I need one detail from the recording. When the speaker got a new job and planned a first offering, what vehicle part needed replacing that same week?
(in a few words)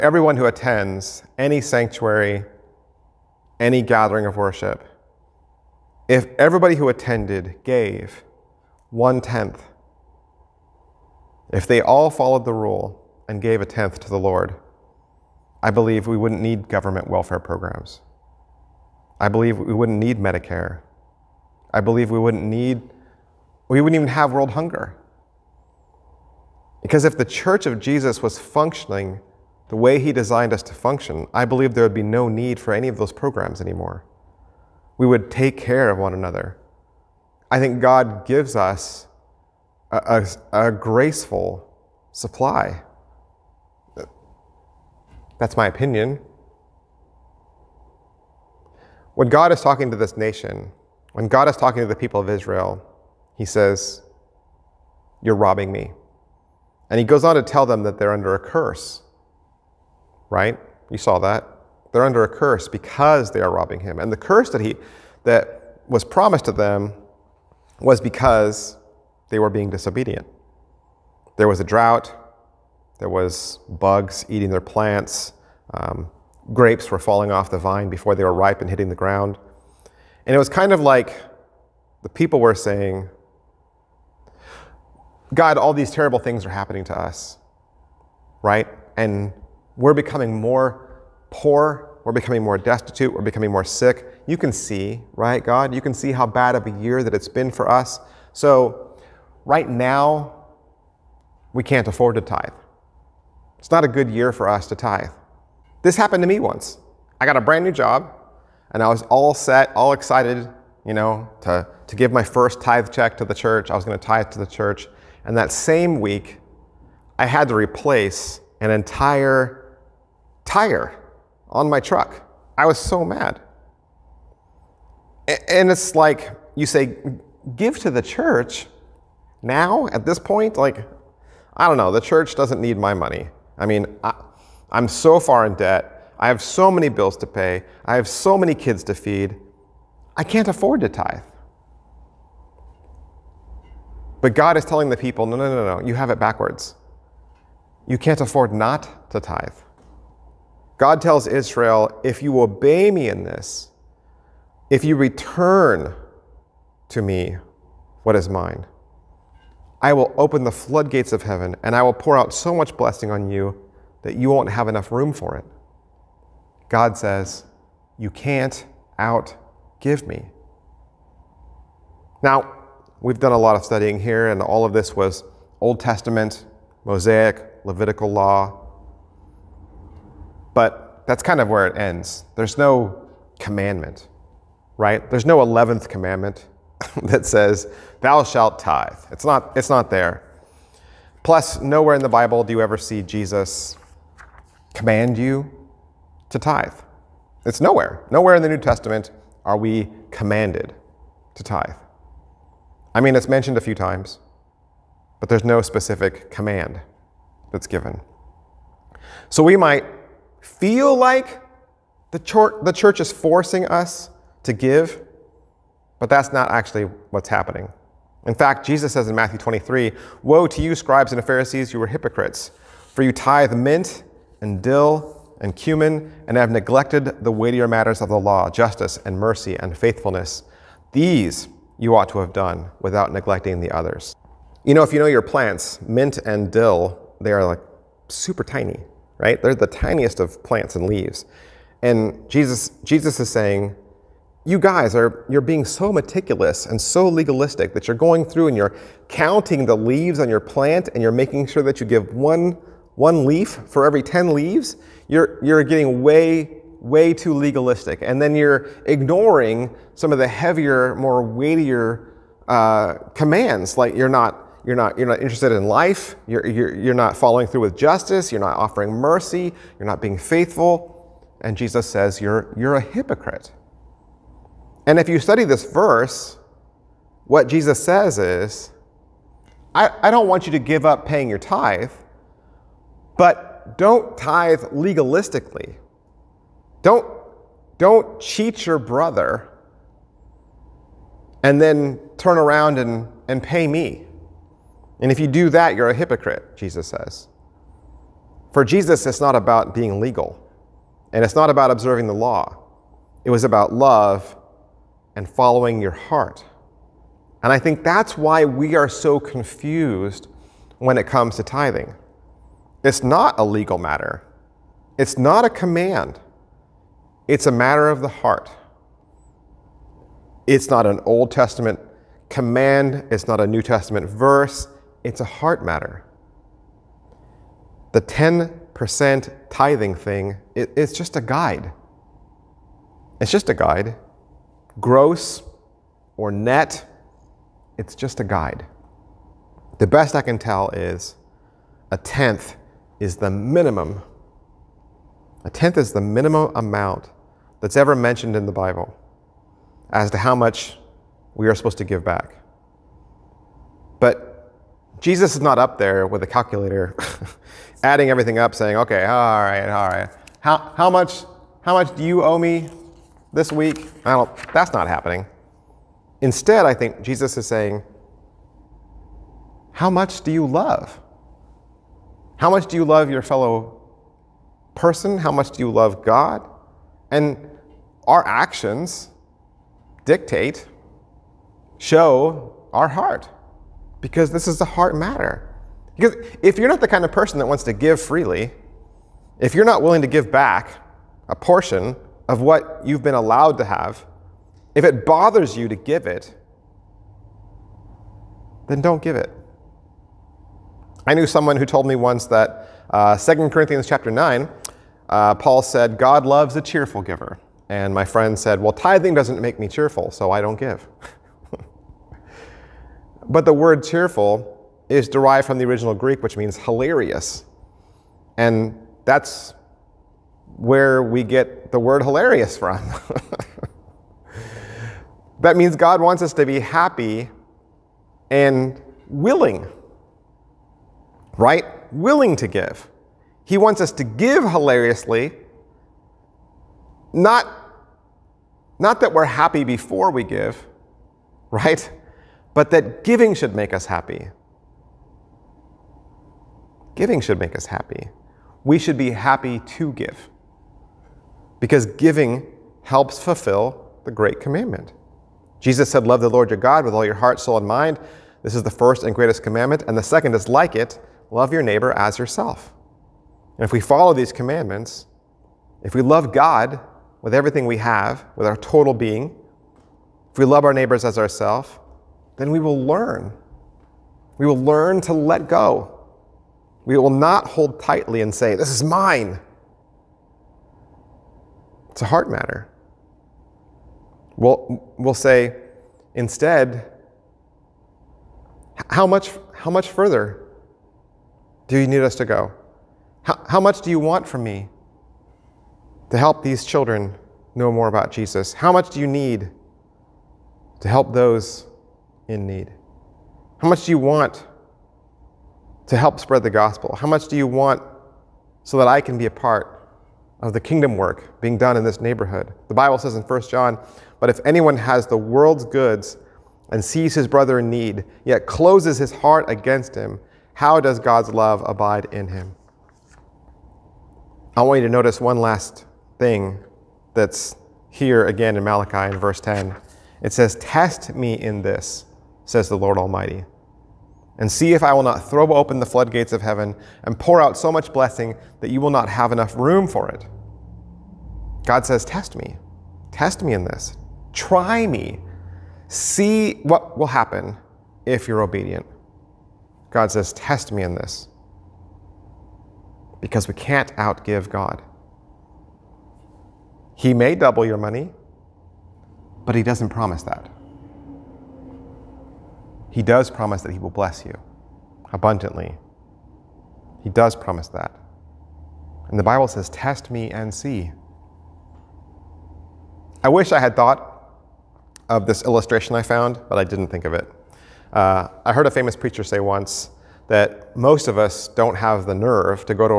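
tire.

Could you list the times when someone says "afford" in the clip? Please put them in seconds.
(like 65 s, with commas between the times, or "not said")
101 s, 140 s, 148 s.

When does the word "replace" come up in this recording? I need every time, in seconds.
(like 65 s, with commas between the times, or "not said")
117 s.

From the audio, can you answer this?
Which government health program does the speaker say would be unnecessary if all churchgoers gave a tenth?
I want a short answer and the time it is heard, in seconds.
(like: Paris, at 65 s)
Medicare, at 20 s.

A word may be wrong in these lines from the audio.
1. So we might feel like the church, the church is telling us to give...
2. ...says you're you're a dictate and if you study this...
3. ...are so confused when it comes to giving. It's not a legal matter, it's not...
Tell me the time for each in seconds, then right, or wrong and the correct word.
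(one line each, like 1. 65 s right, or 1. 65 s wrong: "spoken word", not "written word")
1. 209 s wrong: "forcing", not "telling"
2. 271 s wrong: "hypocrite", not "dictate"
3. 308 s wrong: "tithing", not "giving".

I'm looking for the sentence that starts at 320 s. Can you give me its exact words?
It's not an Old Testament command, it's not a New Testament verse, it's a heart matter.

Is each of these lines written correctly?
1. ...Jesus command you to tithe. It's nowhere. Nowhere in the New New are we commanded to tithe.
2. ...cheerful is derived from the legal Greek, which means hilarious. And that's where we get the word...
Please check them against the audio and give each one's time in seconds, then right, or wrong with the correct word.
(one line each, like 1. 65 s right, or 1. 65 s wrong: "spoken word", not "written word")
1. 193 s wrong: "Testament", not "New"
2. 413 s wrong: "original", not "legal".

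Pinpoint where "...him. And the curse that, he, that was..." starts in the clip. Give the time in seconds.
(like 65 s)
63 s.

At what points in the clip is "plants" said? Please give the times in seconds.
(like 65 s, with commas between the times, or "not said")
74 s, 235 s, 240 s, 250 s.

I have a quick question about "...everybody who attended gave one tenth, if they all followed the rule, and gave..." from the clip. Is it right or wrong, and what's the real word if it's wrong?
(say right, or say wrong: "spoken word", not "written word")
right.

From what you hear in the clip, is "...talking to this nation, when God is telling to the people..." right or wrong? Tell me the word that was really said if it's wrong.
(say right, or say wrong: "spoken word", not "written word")
wrong: "talking", not "telling".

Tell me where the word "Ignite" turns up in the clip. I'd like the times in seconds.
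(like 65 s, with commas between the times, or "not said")
not said.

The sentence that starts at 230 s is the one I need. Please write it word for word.
These you ought to have done without neglecting the others.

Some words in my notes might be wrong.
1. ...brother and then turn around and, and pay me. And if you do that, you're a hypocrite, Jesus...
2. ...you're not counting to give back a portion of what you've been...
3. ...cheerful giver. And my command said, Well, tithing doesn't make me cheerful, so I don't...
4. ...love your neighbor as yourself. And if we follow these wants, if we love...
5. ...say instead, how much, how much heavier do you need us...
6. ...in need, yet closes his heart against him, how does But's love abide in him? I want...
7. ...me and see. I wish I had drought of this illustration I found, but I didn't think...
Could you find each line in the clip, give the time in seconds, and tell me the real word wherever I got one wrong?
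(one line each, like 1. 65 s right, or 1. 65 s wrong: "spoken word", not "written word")
1. 288 s right
2. 389 s wrong: "willing", not "counting"
3. 406 s wrong: "friend", not "command"
4. 461 s wrong: "commandments", not "wants"
5. 485 s wrong: "further", not "heavier"
6. 517 s wrong: "God", not "But"
7. 570 s wrong: "thought", not "drought".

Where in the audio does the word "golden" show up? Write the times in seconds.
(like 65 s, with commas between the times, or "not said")
not said.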